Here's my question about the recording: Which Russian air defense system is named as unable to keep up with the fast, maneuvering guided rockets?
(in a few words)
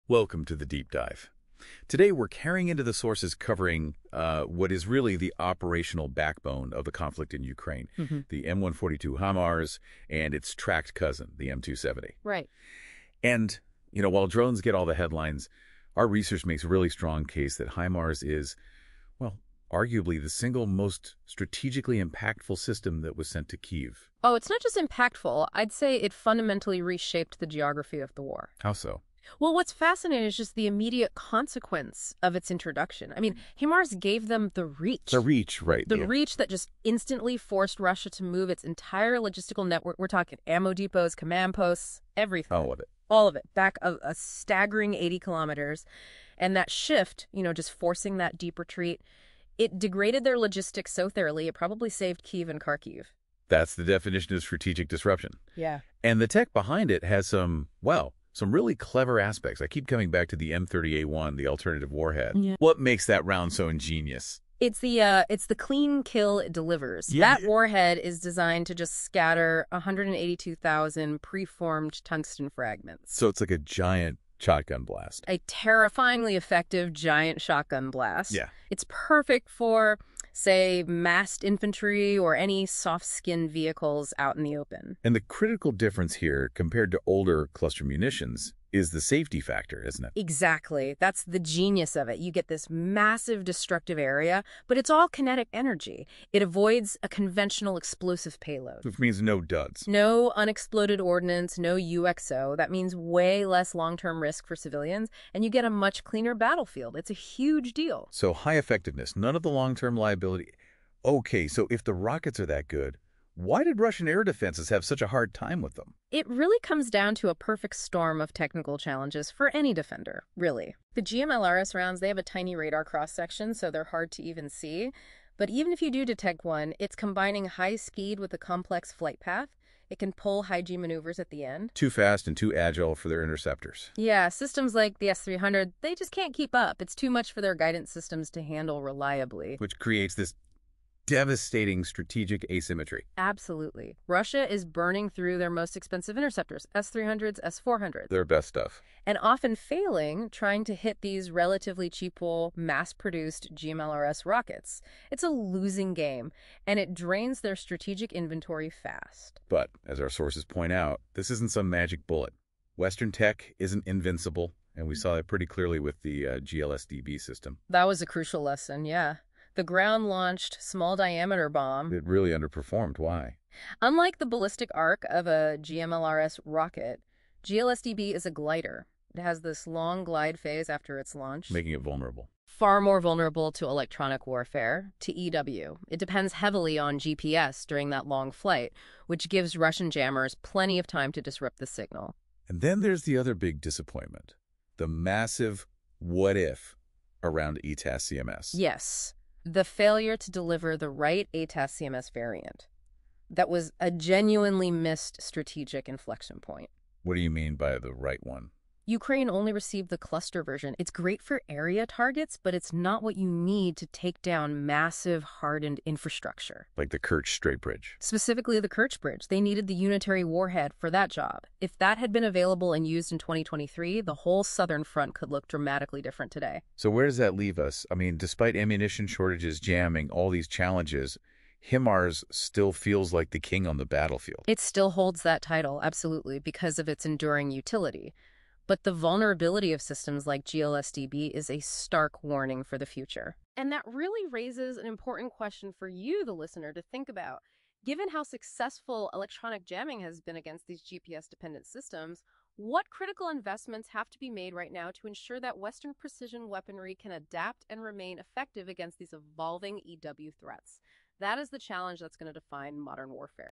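S-300.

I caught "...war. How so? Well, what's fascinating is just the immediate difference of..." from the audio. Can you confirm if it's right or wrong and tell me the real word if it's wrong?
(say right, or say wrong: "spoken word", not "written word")
wrong: "consequence", not "difference".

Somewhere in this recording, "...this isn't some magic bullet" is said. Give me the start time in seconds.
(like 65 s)
161 s.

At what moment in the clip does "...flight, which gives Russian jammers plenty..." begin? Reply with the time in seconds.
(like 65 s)
188 s.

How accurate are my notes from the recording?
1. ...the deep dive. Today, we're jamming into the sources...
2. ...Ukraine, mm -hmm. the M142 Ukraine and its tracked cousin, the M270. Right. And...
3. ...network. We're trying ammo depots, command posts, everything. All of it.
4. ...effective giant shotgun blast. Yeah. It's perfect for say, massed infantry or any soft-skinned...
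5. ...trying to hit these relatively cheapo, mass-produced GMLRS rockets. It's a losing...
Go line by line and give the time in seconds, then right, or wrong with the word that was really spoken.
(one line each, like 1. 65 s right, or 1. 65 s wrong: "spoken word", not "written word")
1. 0 s wrong: "carrying", not "jamming"
2. 7 s wrong: "HIMARS", not "Ukraine"
3. 39 s wrong: "talking", not "trying"
4. 76 s right
5. 150 s right.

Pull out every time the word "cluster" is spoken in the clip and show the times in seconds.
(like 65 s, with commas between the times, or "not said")
87 s, 209 s.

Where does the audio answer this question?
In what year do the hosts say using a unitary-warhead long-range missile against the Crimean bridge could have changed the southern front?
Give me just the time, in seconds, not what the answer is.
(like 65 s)
223 s.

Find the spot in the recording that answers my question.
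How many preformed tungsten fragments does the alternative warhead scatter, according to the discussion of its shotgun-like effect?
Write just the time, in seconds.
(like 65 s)
69 s.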